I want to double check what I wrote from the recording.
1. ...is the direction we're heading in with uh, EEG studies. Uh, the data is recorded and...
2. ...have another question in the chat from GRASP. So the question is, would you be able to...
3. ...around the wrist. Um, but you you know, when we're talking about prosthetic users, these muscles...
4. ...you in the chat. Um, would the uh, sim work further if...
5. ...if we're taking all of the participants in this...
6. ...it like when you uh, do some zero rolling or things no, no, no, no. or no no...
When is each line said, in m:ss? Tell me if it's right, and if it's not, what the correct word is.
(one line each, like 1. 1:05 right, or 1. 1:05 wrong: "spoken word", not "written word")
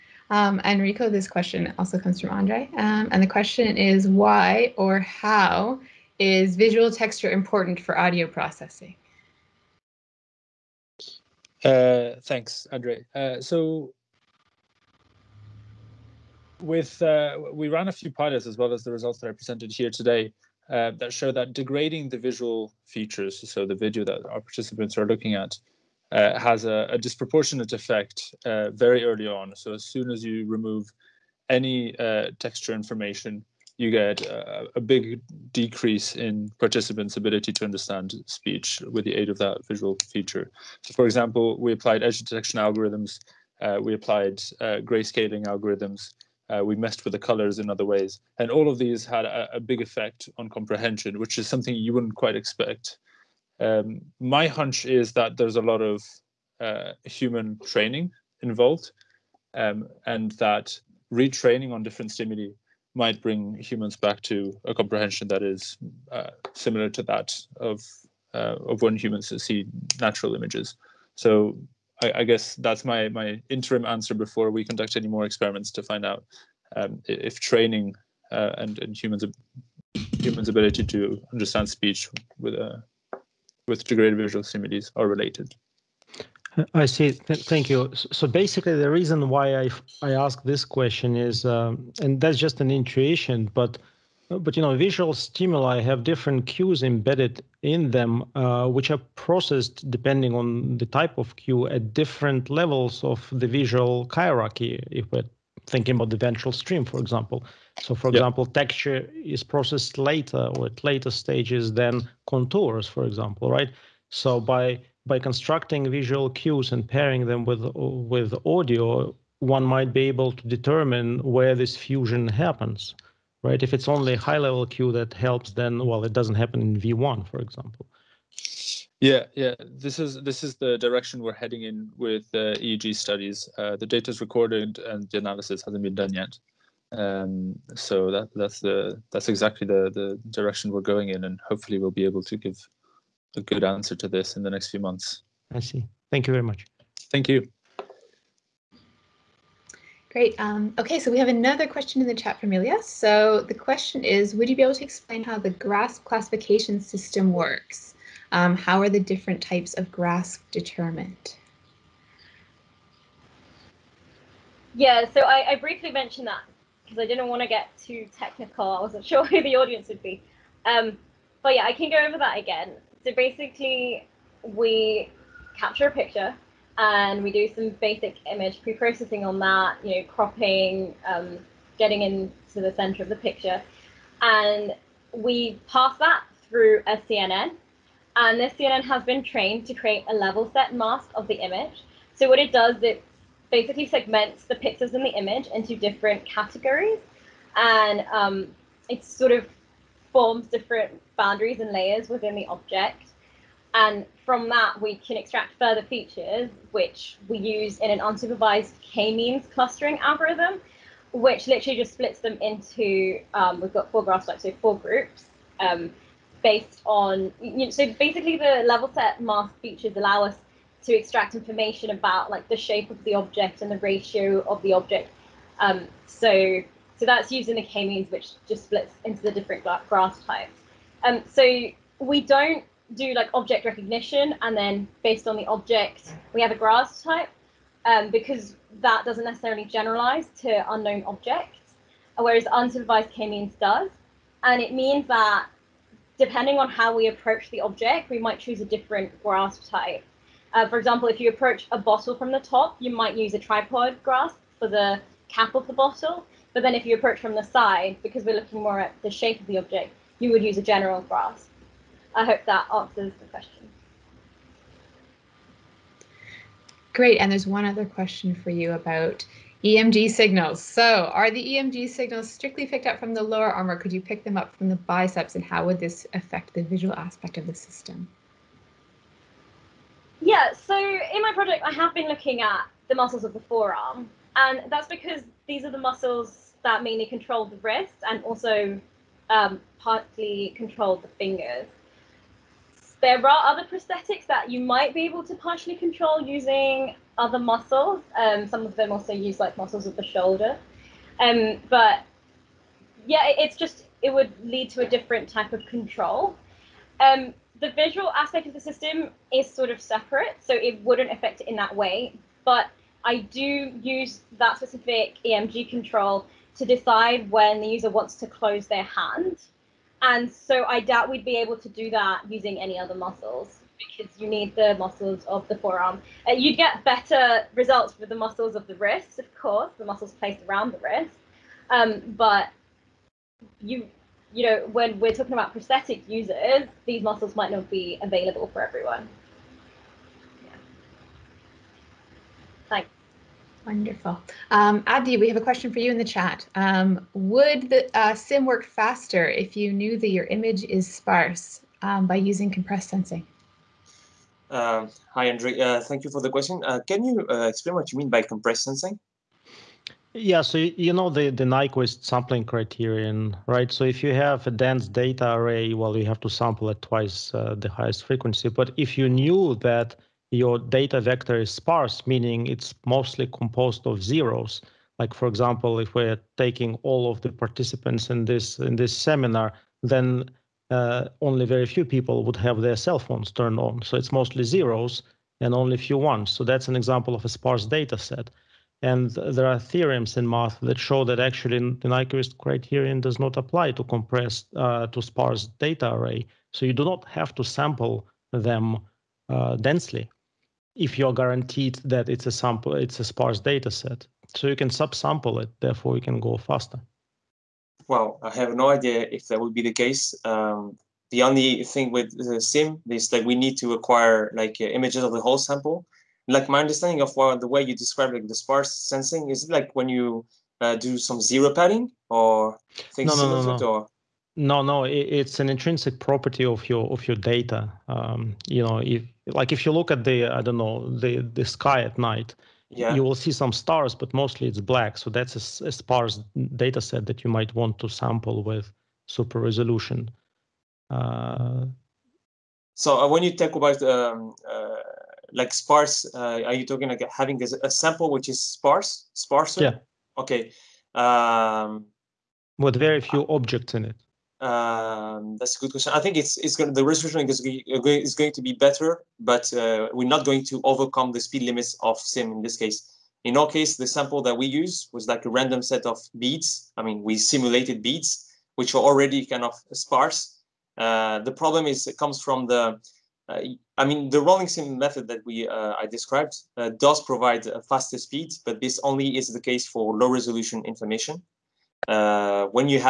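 1. 2:10 right
2. 2:31 wrong: "Ilya", not "GRASP"
3. 5:30 right
4. 5:45 wrong: "faster", not "further"
5. 6:15 right
6. 6:59 wrong: "padding", not "rolling".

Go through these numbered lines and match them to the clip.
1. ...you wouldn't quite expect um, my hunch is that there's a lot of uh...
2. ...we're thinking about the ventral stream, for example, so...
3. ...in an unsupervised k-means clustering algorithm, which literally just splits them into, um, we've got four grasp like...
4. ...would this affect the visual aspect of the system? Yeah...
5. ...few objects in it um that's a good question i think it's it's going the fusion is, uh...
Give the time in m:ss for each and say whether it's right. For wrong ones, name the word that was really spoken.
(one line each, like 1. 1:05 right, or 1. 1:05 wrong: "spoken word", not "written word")
1. 0:51 right
2. 1:45 right
3. 3:27 right
4. 4:35 right
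5. 7:33 wrong: "resolution", not "fusion".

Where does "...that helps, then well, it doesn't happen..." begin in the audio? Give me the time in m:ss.
2:04.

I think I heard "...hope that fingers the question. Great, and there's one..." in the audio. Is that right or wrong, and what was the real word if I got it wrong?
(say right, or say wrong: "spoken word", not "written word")
wrong: "answers", not "fingers".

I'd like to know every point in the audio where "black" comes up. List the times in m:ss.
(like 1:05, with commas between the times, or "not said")
7:14.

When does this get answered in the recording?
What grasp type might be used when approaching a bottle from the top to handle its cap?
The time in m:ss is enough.
4:13.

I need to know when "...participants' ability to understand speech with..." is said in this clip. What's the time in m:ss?
0:36.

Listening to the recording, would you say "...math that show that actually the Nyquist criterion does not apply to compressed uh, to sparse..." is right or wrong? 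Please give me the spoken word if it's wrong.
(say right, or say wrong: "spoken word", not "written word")
right.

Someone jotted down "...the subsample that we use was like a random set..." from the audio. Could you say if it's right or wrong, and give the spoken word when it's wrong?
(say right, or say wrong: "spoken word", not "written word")
wrong: "sample", not "subsample".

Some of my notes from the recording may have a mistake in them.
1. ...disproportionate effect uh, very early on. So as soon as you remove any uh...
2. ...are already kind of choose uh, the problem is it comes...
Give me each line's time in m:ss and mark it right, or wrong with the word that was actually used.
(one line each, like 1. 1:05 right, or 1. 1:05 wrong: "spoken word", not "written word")
1. 0:26 right
2. 7:48 wrong: "sparse", not "choose".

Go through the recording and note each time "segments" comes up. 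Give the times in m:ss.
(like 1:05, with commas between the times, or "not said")
3:13.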